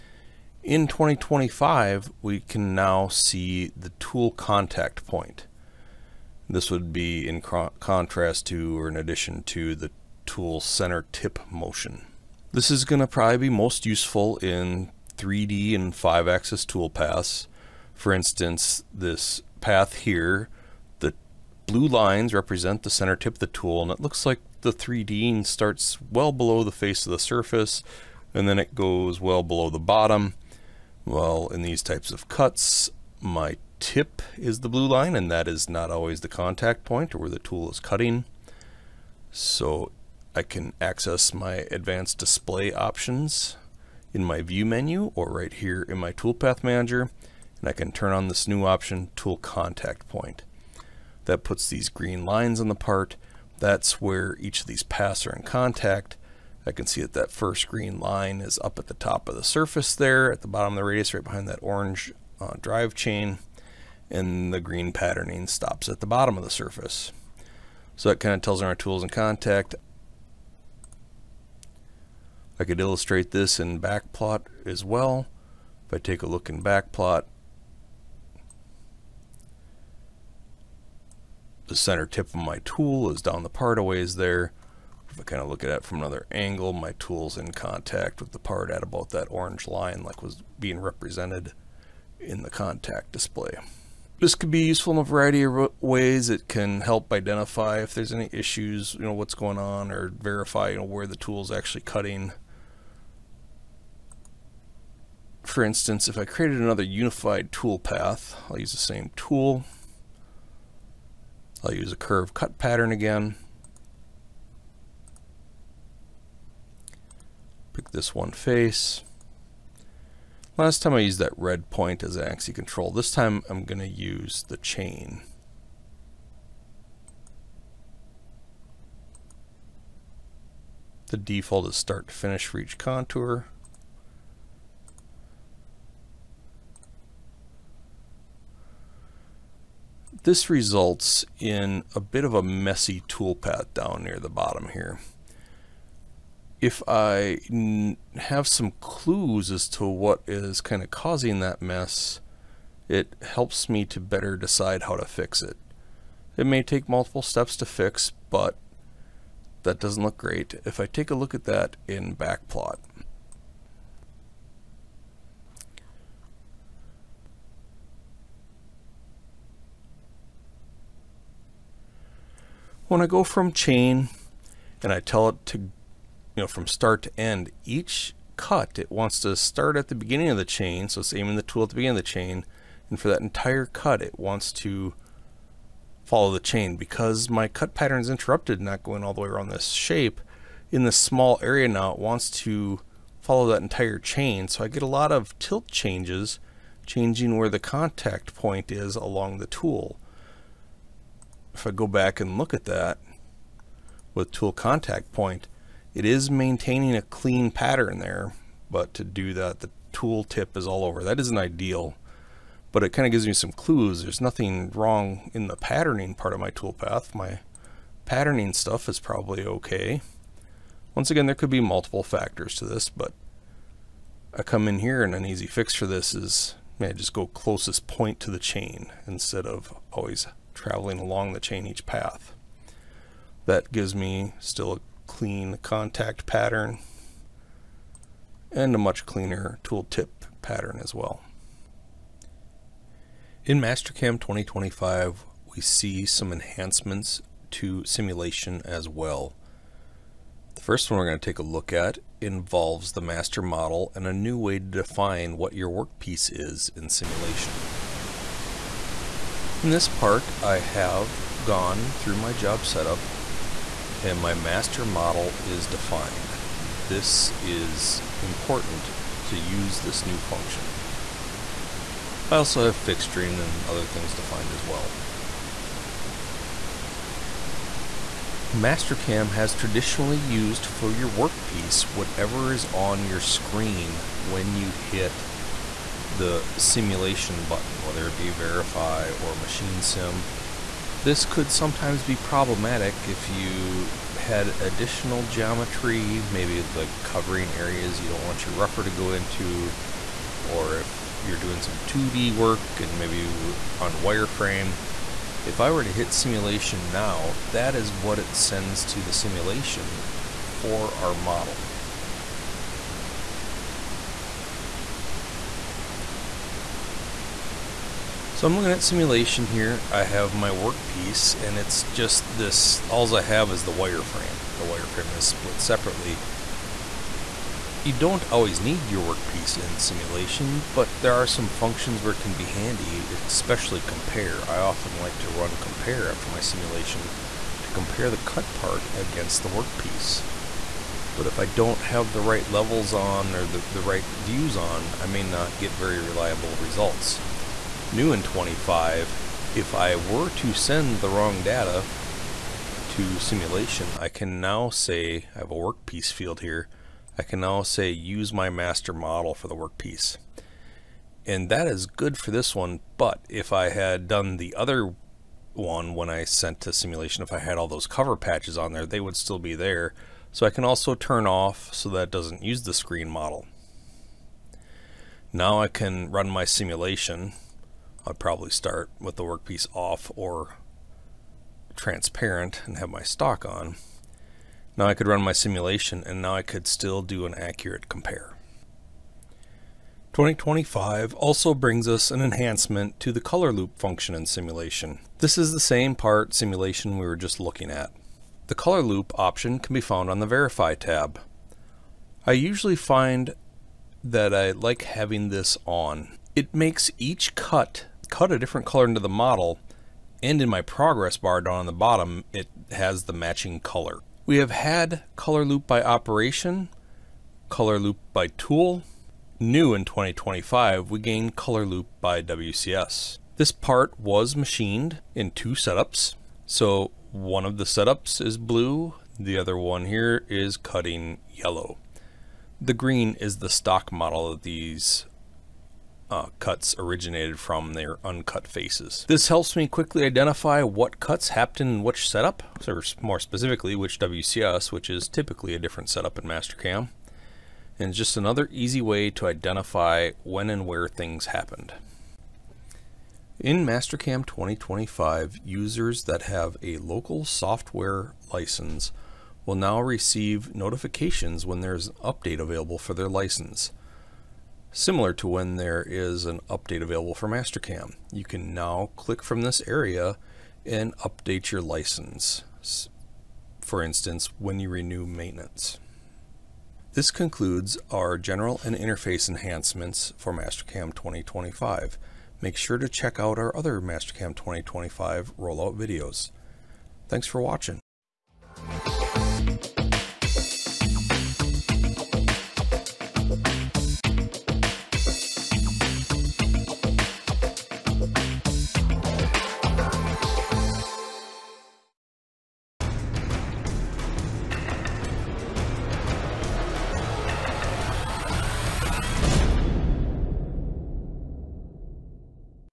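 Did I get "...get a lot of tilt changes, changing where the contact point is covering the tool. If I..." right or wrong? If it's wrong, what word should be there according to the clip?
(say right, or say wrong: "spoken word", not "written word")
wrong: "along", not "covering".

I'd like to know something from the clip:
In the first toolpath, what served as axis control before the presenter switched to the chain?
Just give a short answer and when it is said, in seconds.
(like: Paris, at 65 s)
Red point, at 121 s.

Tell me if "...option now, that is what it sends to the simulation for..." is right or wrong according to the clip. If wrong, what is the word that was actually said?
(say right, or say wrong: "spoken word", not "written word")
wrong: "simulation", not "option".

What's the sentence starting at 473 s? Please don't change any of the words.
For instance, when you renew maintenance.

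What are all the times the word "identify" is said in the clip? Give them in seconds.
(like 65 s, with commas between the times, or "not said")
97 s, 440 s, 449 s.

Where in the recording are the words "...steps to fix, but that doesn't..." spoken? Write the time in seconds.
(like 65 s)
157 s.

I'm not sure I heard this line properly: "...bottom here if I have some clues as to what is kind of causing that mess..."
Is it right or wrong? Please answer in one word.
right.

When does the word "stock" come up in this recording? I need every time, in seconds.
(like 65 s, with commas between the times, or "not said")
383 s, 433 s.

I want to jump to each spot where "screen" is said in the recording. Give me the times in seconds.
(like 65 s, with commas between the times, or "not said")
283 s, 372 s.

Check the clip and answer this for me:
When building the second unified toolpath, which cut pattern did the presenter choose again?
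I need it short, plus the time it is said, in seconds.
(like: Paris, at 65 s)
Curve cut, at 111 s.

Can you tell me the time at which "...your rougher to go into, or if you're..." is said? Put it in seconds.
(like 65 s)
298 s.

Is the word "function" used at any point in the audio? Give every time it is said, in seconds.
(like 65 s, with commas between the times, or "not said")
270 s, 331 s, 393 s.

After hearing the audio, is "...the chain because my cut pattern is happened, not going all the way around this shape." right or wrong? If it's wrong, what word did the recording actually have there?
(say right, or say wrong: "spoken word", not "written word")
wrong: "interrupted", not "happened".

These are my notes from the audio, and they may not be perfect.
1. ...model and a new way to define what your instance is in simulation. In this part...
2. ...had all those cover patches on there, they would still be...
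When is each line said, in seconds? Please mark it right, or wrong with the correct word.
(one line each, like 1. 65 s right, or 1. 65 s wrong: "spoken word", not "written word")
1. 253 s wrong: "workpiece", not "instance"
2. 367 s right.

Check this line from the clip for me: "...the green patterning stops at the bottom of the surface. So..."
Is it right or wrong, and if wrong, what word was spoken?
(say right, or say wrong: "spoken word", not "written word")
right.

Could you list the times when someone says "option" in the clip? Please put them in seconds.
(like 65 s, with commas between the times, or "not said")
42 s, 48 s, 399 s.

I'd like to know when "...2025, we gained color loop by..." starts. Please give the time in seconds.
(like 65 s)
419 s.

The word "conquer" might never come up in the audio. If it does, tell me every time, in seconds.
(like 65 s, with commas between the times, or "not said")
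not said.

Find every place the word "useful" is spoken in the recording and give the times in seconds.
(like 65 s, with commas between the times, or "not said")
13 s, 94 s.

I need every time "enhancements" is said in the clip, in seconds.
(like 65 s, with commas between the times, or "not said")
246 s, 392 s, 479 s.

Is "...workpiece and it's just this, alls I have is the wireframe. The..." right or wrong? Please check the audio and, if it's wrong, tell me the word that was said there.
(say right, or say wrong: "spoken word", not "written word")
right.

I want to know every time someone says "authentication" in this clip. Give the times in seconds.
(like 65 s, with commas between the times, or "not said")
not said.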